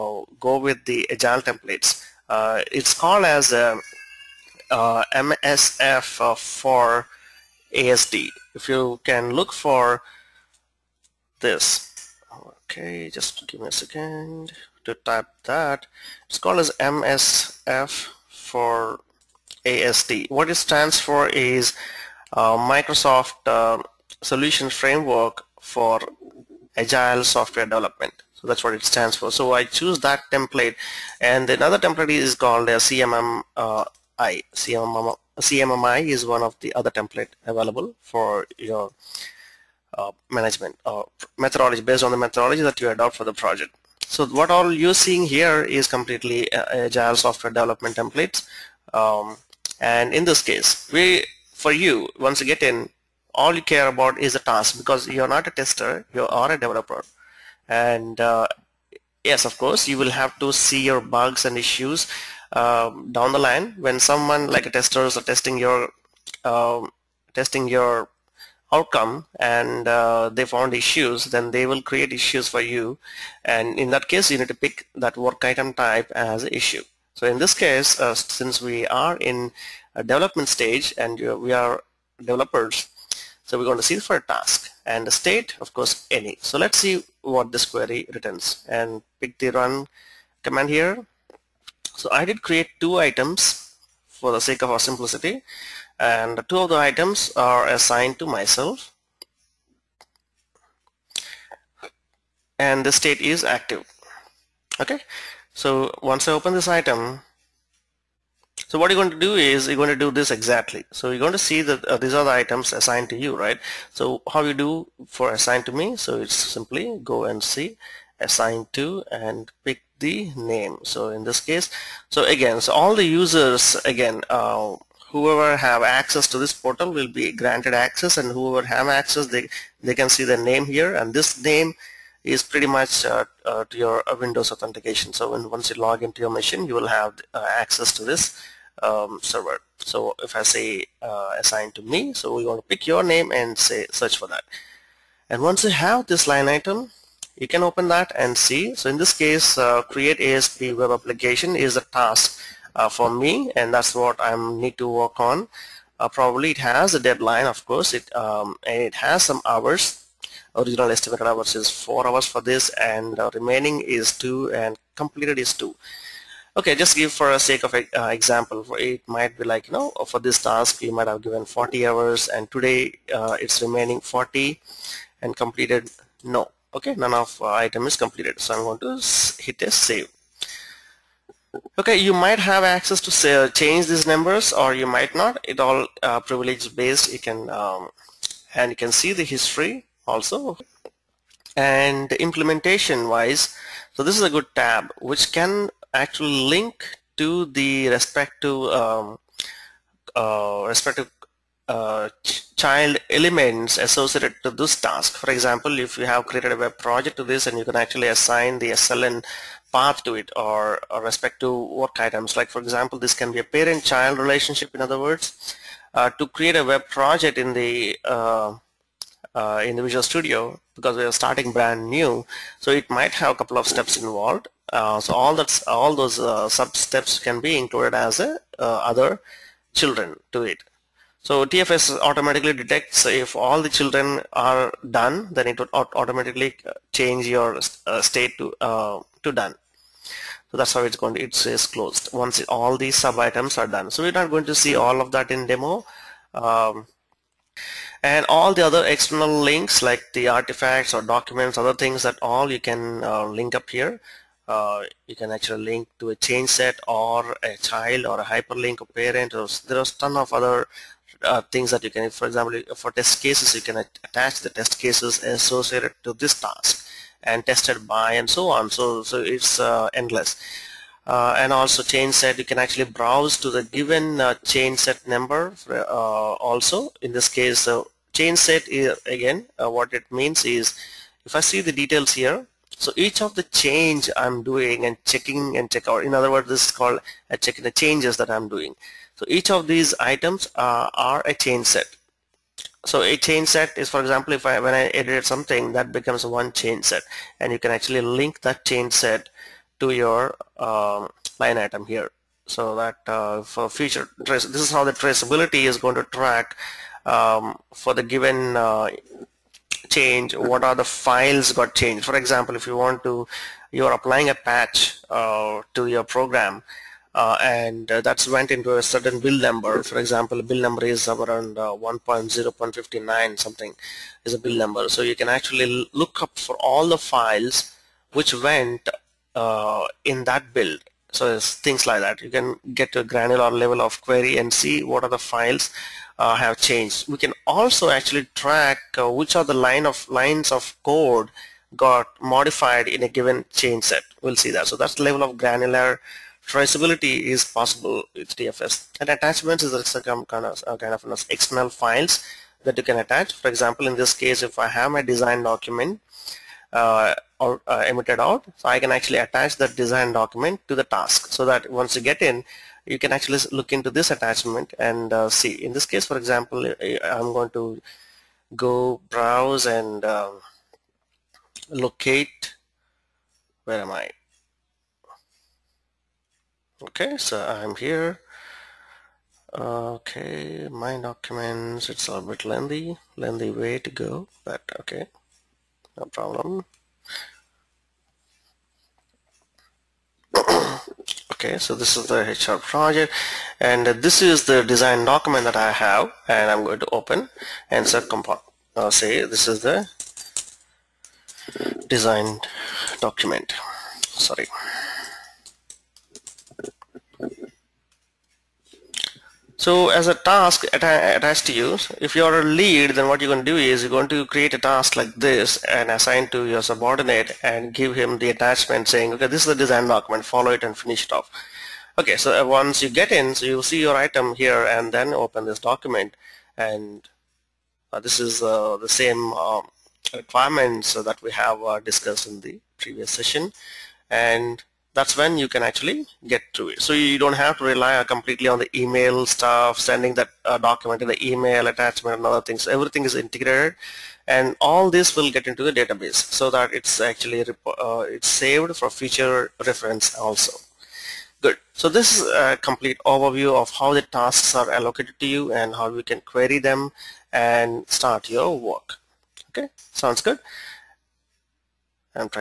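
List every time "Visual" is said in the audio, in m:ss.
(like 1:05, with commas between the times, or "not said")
3:39.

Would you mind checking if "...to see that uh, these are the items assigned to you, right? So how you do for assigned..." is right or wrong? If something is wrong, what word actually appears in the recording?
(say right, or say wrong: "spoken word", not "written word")
right.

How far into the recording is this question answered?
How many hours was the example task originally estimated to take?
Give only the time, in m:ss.
2:41.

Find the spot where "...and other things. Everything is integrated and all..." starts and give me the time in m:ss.
7:22.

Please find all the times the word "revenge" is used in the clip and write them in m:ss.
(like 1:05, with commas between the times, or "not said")
not said.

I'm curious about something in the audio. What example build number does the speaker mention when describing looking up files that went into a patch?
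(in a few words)
1.0.59.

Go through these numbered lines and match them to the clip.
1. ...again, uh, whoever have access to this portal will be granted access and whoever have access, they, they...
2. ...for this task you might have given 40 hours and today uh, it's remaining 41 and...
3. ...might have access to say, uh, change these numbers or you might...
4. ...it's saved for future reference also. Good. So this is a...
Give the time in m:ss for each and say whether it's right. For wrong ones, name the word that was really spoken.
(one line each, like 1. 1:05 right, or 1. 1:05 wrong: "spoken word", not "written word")
1. 2:03 right
2. 2:50 wrong: "40", not "41"
3. 3:02 right
4. 7:28 right.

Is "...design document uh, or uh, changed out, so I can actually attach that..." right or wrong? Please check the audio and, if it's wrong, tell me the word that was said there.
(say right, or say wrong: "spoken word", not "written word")
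wrong: "emitted", not "changed".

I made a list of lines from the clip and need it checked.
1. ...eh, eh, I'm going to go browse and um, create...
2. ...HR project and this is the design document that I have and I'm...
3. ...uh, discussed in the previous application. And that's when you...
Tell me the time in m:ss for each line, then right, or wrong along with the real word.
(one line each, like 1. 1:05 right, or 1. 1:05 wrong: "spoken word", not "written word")
1. 6:06 wrong: "locate", not "create"
2. 6:32 right
3. 7:11 wrong: "session", not "application".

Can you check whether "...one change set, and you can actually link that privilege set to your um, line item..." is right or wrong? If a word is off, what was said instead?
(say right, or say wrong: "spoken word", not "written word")
wrong: "change", not "privilege".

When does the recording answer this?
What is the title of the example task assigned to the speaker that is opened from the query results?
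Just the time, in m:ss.
2:29.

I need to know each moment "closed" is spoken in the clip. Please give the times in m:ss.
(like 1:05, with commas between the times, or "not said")
4:01.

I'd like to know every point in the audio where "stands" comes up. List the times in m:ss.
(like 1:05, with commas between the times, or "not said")
0:20, 0:28.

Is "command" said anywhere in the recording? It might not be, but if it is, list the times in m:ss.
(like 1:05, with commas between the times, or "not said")
1:30.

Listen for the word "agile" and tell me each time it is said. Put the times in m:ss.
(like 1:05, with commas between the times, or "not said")
0:01, 0:26, 0:46.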